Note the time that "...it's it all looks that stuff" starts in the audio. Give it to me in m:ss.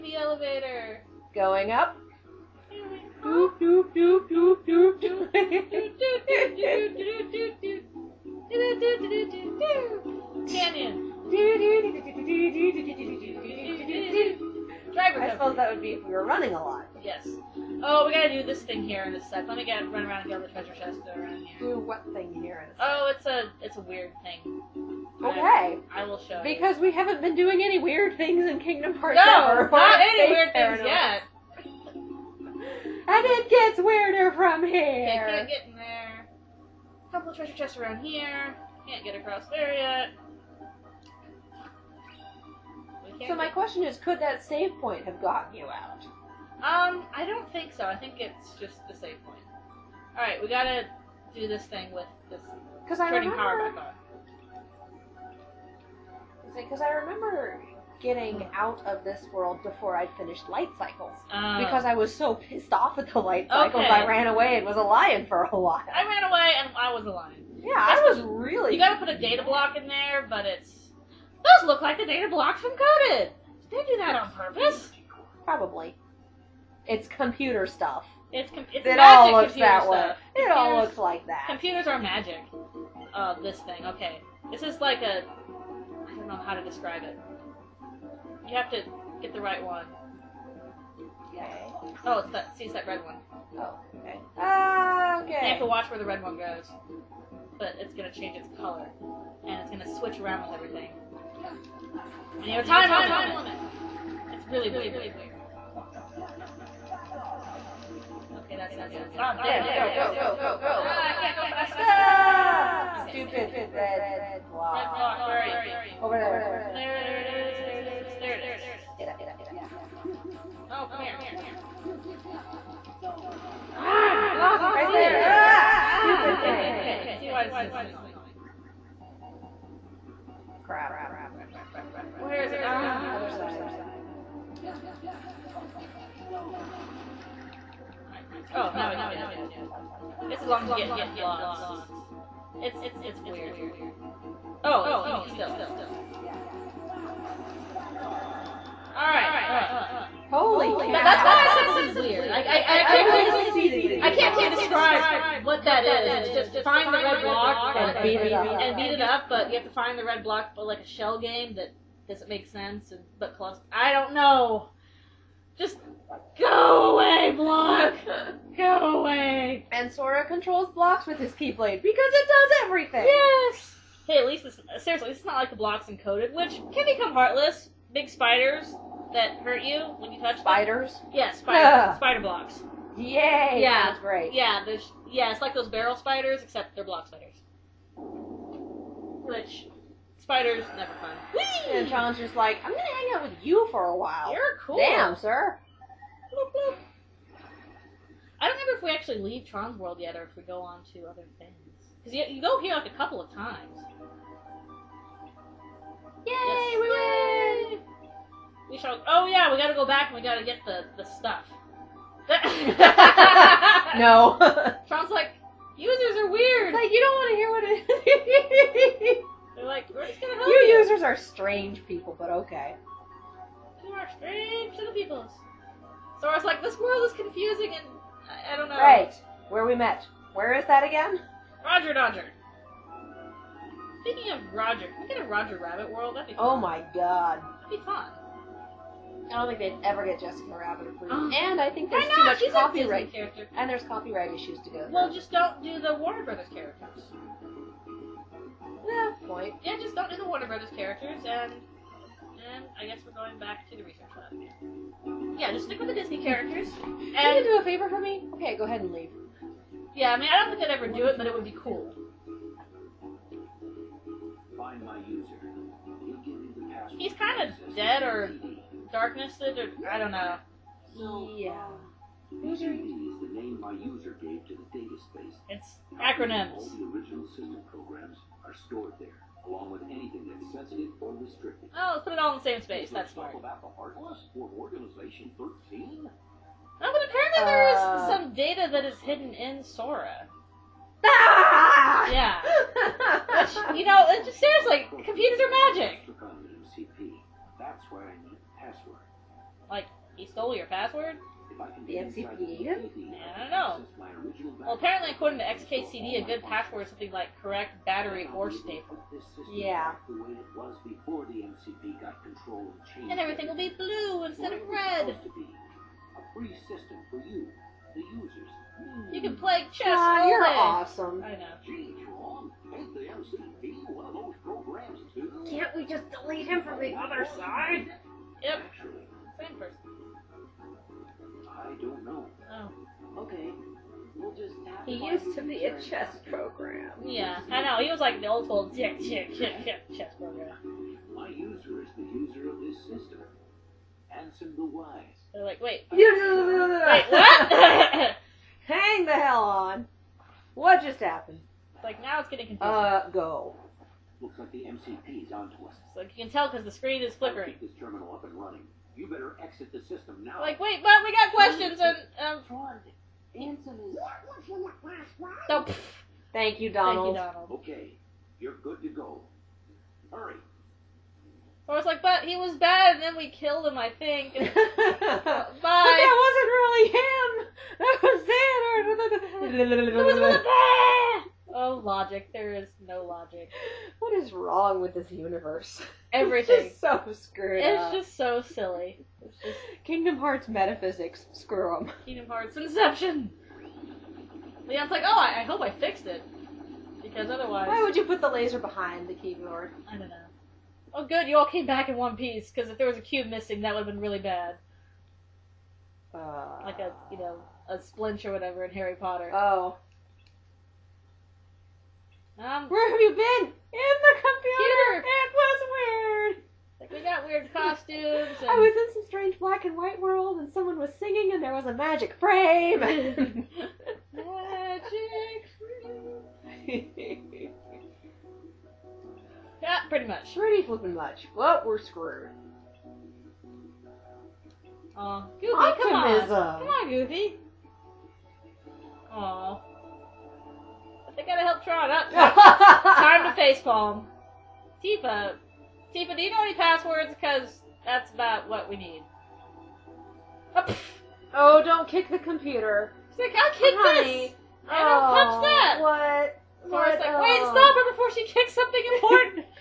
1:18.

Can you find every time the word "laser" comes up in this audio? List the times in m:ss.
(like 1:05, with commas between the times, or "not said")
6:38.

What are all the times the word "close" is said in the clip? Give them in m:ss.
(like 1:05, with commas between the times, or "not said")
2:43.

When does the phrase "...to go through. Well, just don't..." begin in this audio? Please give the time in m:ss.
4:04.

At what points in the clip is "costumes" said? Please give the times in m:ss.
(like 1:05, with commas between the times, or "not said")
6:57.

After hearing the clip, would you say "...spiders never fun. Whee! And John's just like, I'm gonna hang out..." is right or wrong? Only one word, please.
right.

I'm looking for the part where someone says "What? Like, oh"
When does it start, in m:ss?
7:36.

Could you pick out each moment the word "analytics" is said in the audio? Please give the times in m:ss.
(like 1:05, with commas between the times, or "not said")
not said.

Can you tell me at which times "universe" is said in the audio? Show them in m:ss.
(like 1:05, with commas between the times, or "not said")
6:25.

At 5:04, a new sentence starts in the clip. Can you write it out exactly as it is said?
Well, apparently, according to XKCD, a good password is something like correct, battery, or staple.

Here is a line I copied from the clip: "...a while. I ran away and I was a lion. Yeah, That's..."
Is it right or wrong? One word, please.
right.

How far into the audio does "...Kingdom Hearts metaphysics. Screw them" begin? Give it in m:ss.
6:29.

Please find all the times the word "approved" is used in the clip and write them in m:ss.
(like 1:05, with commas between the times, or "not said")
4:00.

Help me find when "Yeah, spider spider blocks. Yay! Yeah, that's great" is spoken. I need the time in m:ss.
3:01.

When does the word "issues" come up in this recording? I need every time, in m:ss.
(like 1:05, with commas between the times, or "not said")
4:04.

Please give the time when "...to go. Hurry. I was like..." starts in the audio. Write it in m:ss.
6:08.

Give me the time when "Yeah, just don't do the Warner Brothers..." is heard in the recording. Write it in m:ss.
4:09.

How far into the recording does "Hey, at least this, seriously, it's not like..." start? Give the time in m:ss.
2:54.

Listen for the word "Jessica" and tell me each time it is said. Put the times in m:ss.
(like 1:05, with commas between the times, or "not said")
4:00.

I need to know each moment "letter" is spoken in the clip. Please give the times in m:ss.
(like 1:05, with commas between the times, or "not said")
not said.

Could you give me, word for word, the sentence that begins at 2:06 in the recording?
Okay, you can see why this is annoying.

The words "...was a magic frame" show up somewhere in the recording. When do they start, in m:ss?
7:01.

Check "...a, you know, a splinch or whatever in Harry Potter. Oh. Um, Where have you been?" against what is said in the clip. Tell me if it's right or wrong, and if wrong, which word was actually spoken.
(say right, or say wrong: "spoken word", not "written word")
right.